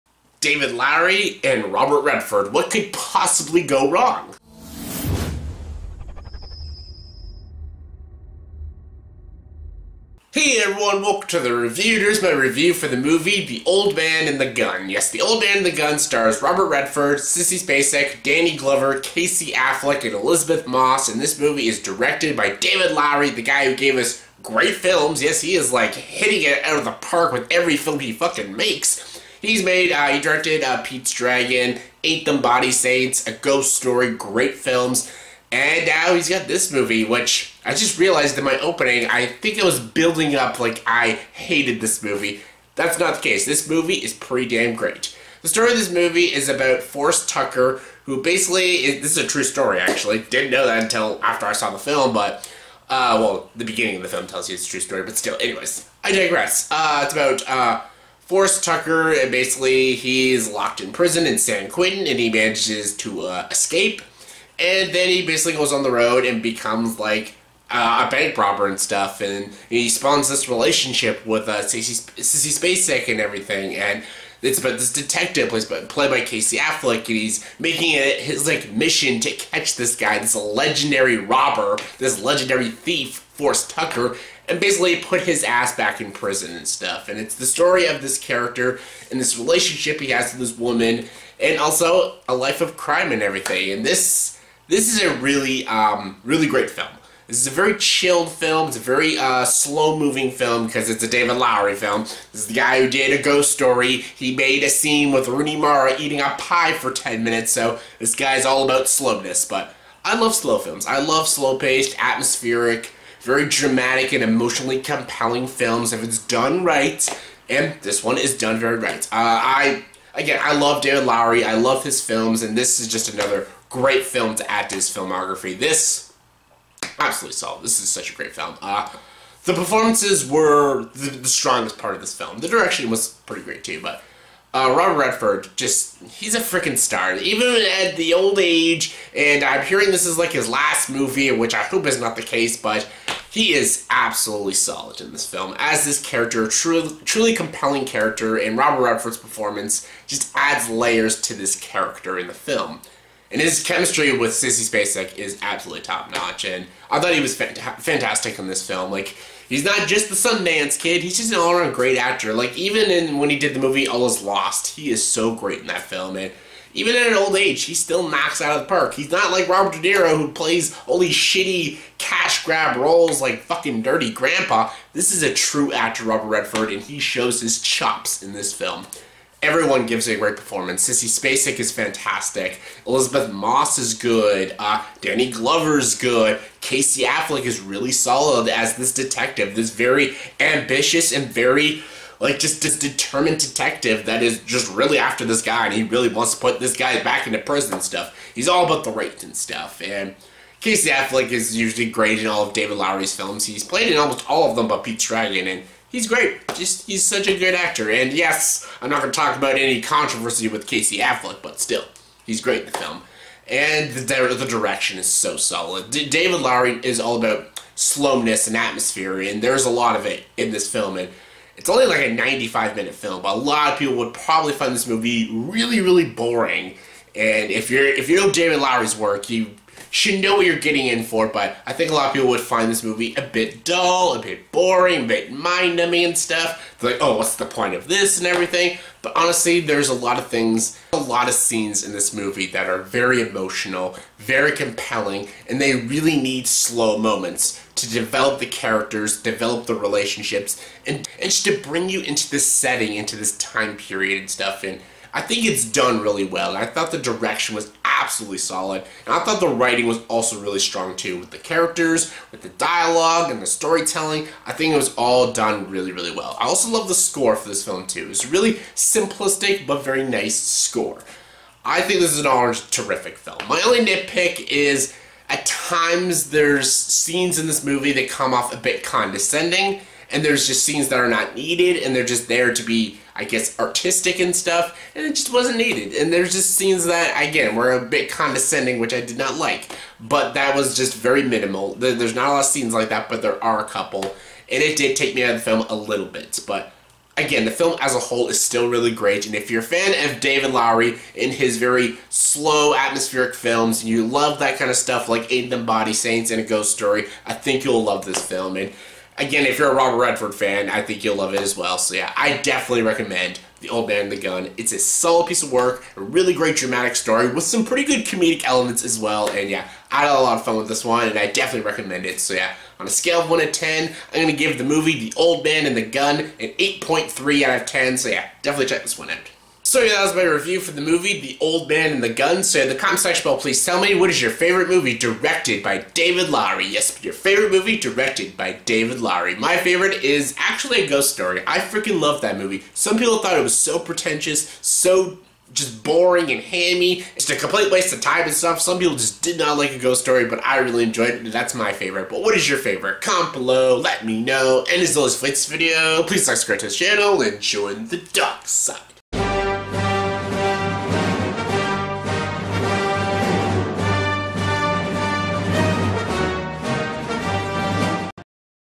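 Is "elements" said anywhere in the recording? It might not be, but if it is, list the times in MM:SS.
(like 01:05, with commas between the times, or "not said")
05:18.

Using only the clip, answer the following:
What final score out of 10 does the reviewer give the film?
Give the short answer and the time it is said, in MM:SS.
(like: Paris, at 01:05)
8.3, at 05:26.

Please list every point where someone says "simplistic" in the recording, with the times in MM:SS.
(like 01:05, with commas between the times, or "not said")
04:28.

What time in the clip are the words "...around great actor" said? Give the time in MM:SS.
02:41.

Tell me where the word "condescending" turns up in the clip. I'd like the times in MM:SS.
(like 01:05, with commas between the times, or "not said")
04:38, 04:48.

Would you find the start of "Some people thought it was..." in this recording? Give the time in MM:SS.
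05:42.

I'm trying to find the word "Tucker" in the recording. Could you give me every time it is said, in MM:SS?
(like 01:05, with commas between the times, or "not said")
00:47, 00:58, 01:23.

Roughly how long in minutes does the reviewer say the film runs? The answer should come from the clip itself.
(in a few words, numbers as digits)
95.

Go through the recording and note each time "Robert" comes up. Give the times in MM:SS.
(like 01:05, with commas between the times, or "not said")
00:01, 00:16, 02:14, 02:28, 02:49, 02:56, 05:09.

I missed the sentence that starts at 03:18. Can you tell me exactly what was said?
He's all about the rape and stuff and Casey Affleck is usually great in all of David Lowery's films.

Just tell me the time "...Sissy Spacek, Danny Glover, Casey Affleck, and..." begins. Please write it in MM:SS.
00:17.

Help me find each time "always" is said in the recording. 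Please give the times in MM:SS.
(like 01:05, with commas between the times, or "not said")
05:54.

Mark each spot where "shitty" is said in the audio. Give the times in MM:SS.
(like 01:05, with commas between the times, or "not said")
02:51.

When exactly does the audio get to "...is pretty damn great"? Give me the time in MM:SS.
00:43.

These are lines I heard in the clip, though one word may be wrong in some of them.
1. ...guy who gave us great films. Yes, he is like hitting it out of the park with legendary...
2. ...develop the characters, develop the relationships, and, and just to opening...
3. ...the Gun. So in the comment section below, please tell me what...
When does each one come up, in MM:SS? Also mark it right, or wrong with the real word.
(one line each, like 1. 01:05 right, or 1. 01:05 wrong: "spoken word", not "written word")
1. 00:23 wrong: "every", not "legendary"
2. 04:07 wrong: "bring", not "opening"
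3. 05:32 right.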